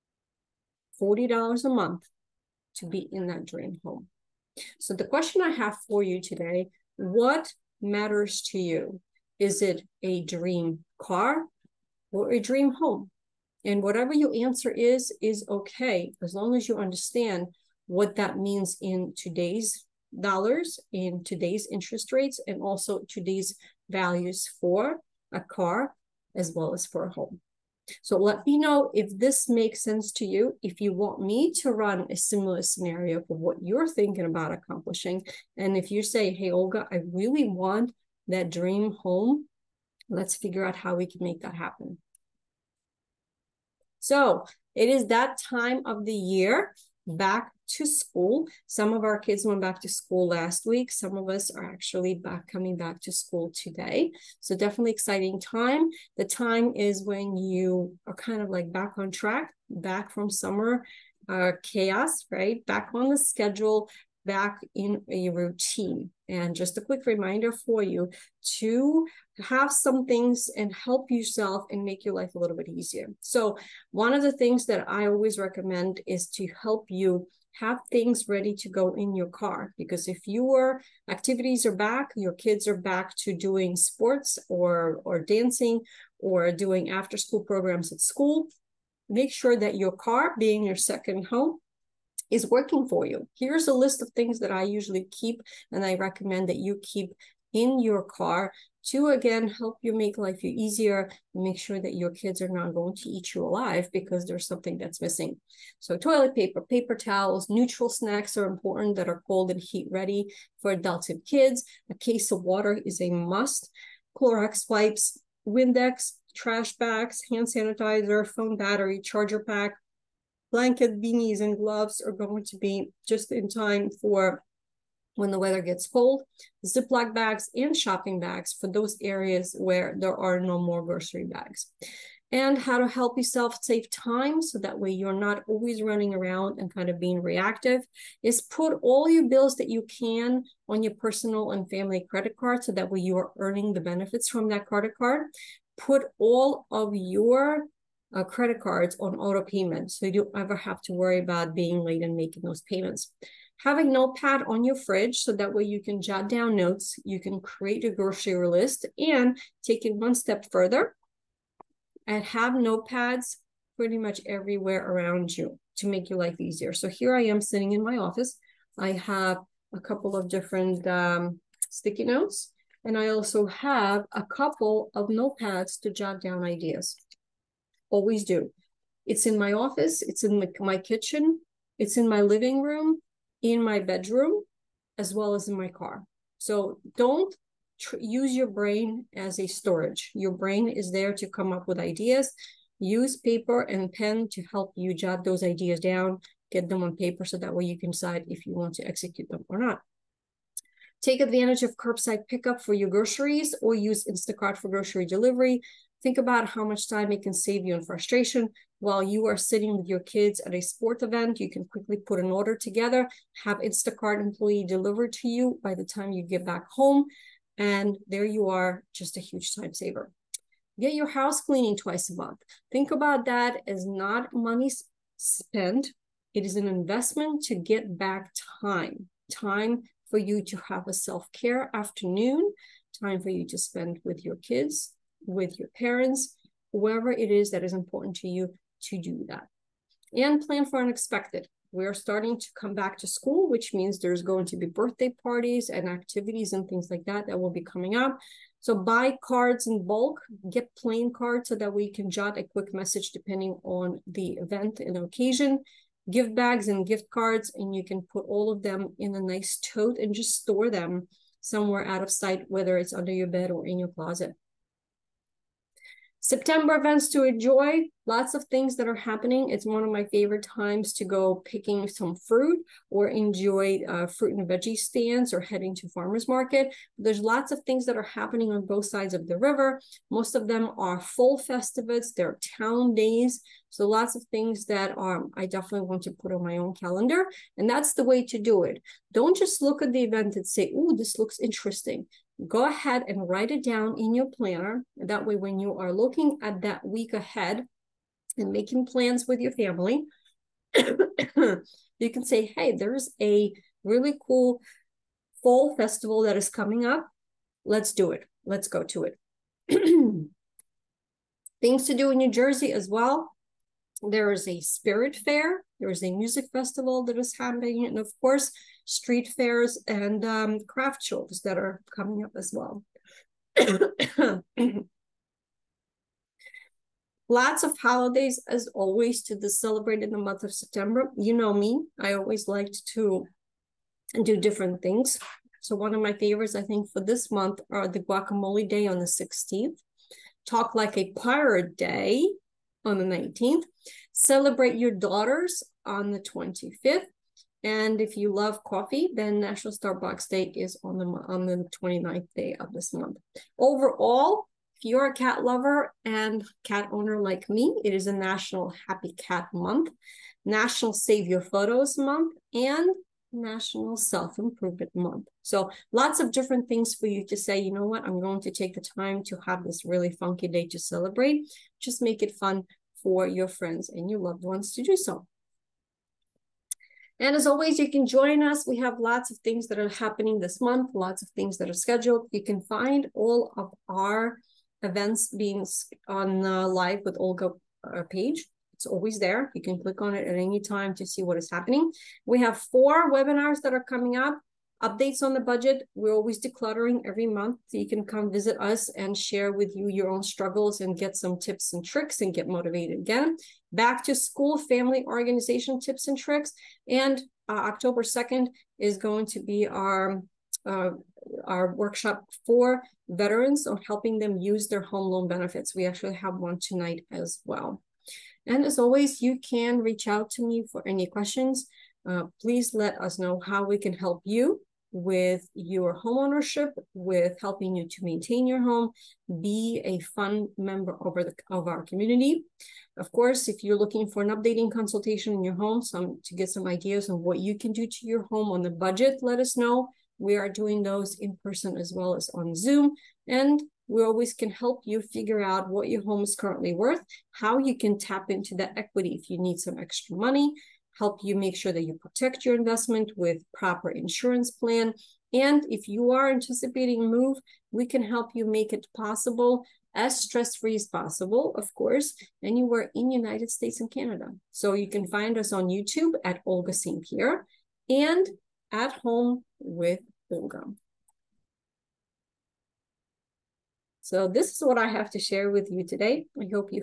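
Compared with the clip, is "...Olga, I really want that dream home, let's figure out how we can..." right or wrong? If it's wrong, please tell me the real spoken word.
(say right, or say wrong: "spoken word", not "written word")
right.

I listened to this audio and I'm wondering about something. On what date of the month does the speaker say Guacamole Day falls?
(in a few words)
16th.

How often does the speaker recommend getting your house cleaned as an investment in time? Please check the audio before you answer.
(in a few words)
Twice a month.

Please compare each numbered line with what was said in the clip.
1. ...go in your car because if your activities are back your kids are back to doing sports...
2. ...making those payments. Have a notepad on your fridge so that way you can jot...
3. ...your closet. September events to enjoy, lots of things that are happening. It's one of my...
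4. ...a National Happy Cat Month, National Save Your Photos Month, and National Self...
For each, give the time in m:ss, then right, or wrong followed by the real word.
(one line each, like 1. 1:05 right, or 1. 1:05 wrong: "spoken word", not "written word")
1. 1:18 right
2. 2:32 right
3. 4:23 right
4. 5:58 right.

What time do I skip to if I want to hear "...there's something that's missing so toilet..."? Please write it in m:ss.
1:44.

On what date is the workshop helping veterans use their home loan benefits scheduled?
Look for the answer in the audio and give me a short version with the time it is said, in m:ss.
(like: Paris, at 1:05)
October 2, at 6:47.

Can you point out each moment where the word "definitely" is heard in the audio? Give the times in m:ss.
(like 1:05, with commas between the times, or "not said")
0:54, 4:45.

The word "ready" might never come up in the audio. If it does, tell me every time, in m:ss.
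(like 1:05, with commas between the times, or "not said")
1:18, 1:49.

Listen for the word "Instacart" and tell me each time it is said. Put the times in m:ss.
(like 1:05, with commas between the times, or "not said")
3:24, 3:33.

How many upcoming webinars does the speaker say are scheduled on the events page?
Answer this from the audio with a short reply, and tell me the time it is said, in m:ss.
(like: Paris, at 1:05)
4, at 6:32.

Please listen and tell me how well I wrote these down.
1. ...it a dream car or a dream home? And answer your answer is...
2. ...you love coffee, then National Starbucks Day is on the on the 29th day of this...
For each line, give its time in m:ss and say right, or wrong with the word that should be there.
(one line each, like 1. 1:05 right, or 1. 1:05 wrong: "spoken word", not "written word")
1. 0:09 wrong: "whatever", not "answer"
2. 5:48 right.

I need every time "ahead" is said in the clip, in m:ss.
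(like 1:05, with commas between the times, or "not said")
4:52, 4:57.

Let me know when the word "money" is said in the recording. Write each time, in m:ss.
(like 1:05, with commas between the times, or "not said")
3:44, 7:30.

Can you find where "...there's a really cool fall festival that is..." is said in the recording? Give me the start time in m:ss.
5:02.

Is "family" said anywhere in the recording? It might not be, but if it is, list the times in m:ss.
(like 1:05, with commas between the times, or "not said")
2:21, 4:59, 6:44.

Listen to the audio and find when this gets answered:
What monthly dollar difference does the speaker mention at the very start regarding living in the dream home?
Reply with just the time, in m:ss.
0:00.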